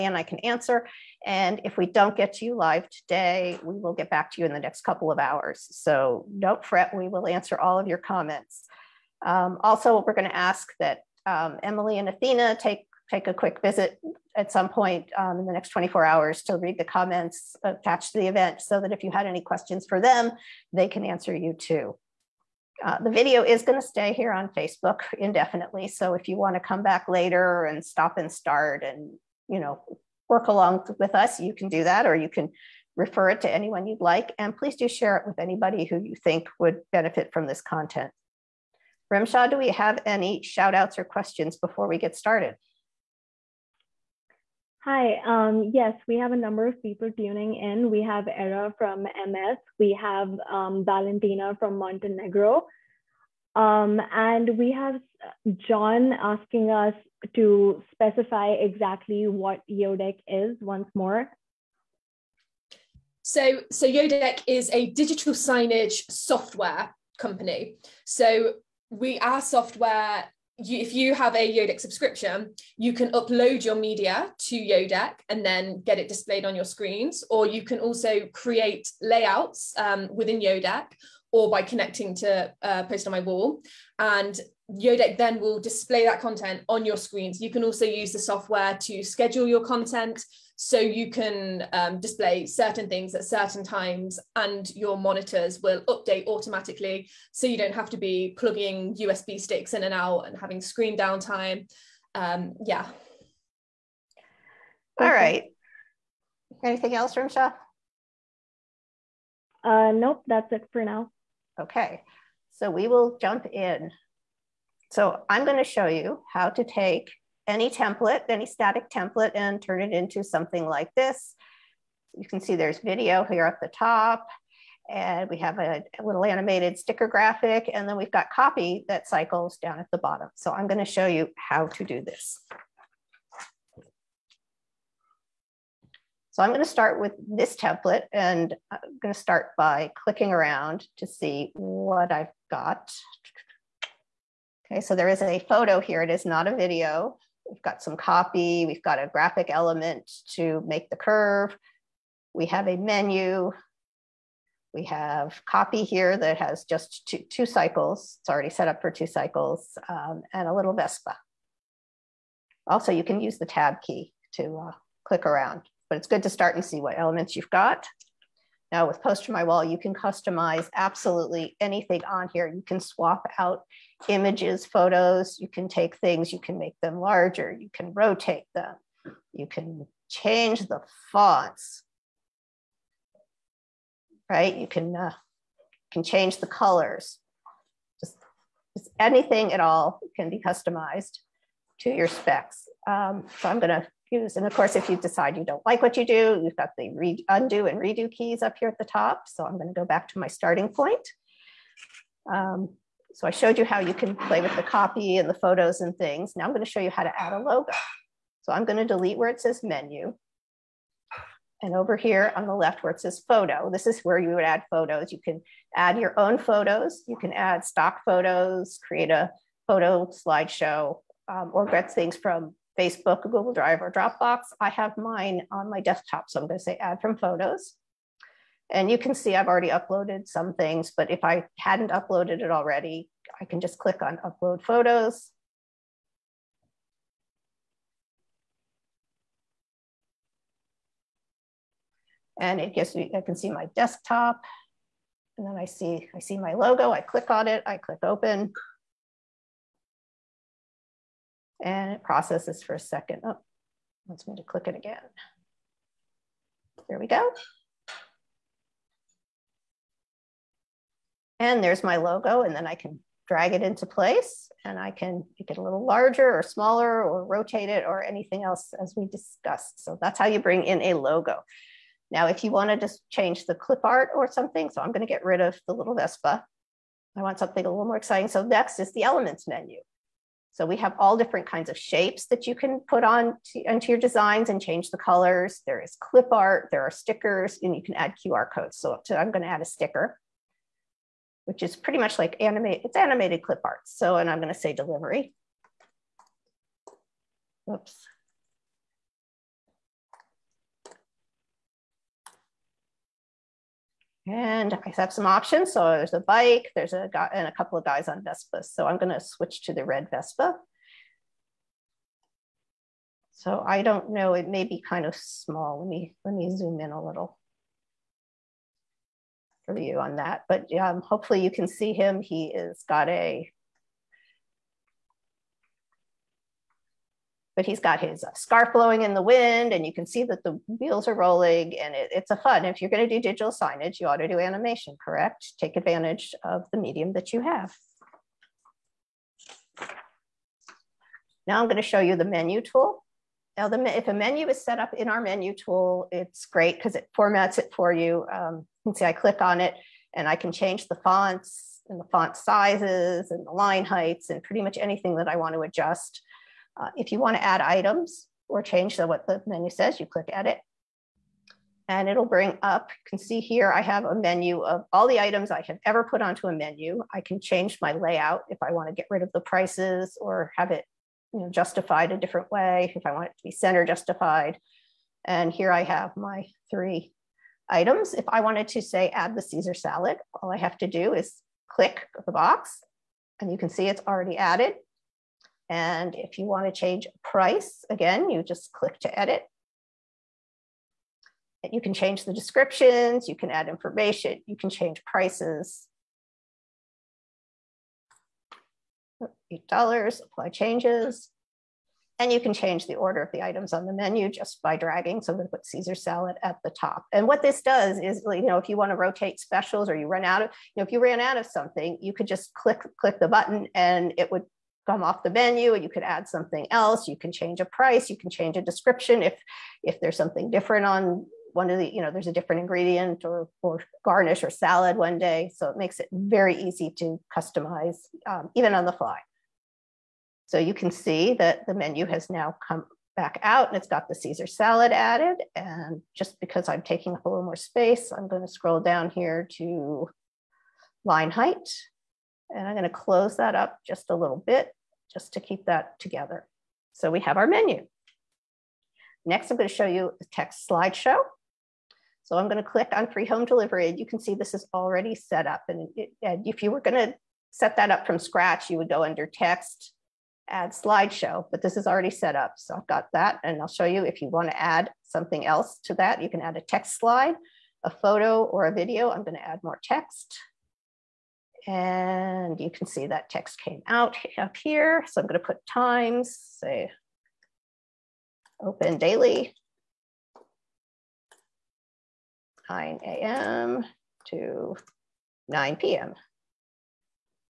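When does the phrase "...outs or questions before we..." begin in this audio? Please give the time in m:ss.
0:40.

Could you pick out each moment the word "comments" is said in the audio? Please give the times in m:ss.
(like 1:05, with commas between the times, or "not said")
0:07, 0:16.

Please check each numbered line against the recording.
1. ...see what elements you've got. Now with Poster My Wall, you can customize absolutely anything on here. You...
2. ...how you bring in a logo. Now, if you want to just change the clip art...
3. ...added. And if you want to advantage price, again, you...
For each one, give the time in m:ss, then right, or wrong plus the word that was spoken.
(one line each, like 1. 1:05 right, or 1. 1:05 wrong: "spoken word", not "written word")
1. 2:46 right
2. 4:30 right
3. 6:24 wrong: "change", not "advantage".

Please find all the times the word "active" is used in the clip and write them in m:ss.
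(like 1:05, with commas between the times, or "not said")
not said.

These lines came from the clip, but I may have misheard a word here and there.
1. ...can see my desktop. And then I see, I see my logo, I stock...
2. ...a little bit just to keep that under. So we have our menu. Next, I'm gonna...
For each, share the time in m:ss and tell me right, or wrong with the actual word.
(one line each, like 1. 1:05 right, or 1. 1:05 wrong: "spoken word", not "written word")
1. 4:03 wrong: "click", not "stock"
2. 7:24 wrong: "together", not "under".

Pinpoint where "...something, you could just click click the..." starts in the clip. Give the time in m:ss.
6:51.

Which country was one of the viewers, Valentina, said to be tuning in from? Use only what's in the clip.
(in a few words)
Montenegro.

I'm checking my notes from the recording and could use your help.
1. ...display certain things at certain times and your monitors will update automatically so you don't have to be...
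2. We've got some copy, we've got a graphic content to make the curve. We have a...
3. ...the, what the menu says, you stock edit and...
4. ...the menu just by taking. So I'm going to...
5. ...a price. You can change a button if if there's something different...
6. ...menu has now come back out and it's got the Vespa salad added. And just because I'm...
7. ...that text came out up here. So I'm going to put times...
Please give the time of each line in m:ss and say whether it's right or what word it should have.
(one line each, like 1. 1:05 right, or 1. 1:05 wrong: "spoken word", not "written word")
1. 1:31 right
2. 2:27 wrong: "element", not "content"
3. 5:58 wrong: "click", not "stock"
4. 6:43 wrong: "dragging", not "taking"
5. 6:57 wrong: "description", not "button"
6. 7:11 wrong: "Caesar", not "Vespa"
7. 7:53 right.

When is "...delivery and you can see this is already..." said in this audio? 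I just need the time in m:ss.
7:33.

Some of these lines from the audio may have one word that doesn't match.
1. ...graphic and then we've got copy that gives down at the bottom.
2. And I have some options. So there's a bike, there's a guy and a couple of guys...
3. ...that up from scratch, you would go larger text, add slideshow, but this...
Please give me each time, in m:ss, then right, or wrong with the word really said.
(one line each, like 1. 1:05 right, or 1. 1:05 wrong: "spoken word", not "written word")
1. 2:07 wrong: "cycles", not "gives"
2. 5:04 right
3. 7:37 wrong: "under", not "larger".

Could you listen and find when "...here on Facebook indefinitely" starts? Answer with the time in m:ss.
0:24.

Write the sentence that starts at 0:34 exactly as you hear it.
And please do share it with anybody who you think would benefit from this content.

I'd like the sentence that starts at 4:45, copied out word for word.
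There is clip art, there are stickers, and you can add QR codes.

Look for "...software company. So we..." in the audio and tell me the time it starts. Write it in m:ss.
1:06.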